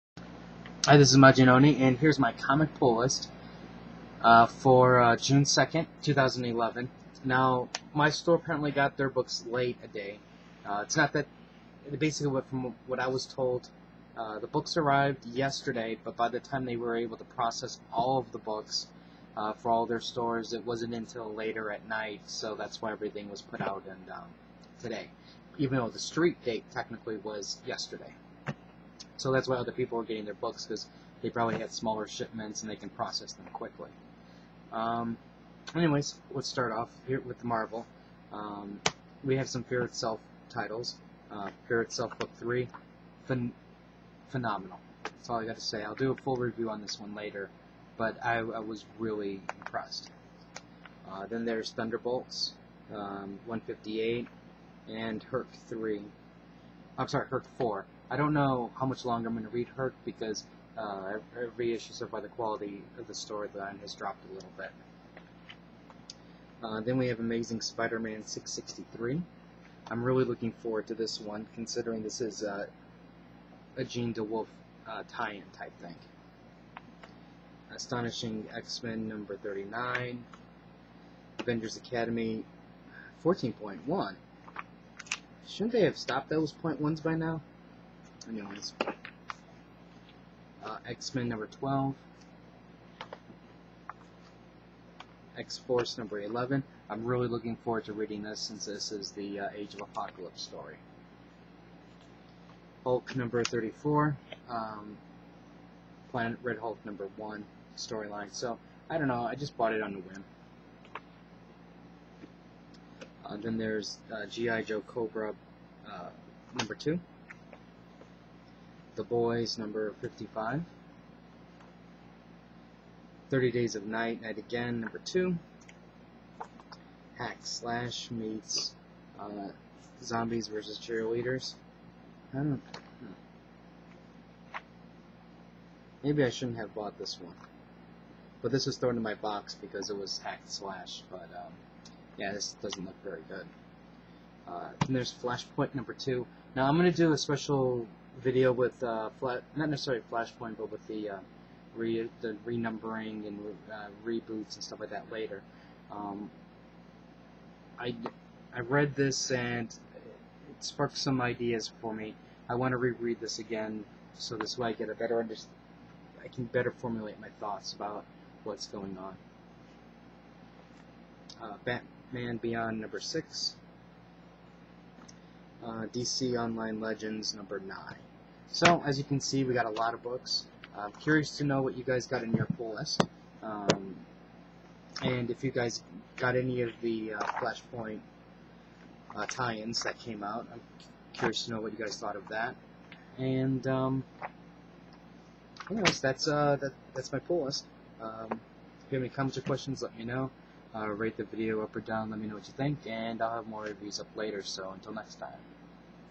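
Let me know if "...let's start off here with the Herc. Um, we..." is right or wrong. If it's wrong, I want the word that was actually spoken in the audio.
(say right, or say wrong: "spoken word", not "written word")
wrong: "Marvel", not "Herc".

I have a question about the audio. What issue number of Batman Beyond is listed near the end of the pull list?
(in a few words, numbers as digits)
6.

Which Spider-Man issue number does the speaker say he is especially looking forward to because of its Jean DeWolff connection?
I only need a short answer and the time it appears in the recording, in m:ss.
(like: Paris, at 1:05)
663, at 1:08.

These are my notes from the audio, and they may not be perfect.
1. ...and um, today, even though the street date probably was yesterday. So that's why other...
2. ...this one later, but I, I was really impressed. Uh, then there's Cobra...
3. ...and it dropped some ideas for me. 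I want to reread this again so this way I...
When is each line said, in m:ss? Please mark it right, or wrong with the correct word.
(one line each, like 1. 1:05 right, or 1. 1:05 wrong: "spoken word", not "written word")
1. 0:23 wrong: "technically", not "probably"
2. 0:46 wrong: "Thunderbolts", not "Cobra"
3. 2:39 wrong: "sparked", not "dropped".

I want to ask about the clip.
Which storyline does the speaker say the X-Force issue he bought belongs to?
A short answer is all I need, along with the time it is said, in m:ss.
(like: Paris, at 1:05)
Age of Apocalypse, at 1:39.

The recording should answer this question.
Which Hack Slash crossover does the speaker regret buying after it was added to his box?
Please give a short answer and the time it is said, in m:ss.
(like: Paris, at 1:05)
Zombies versus Cheerleaders, at 2:10.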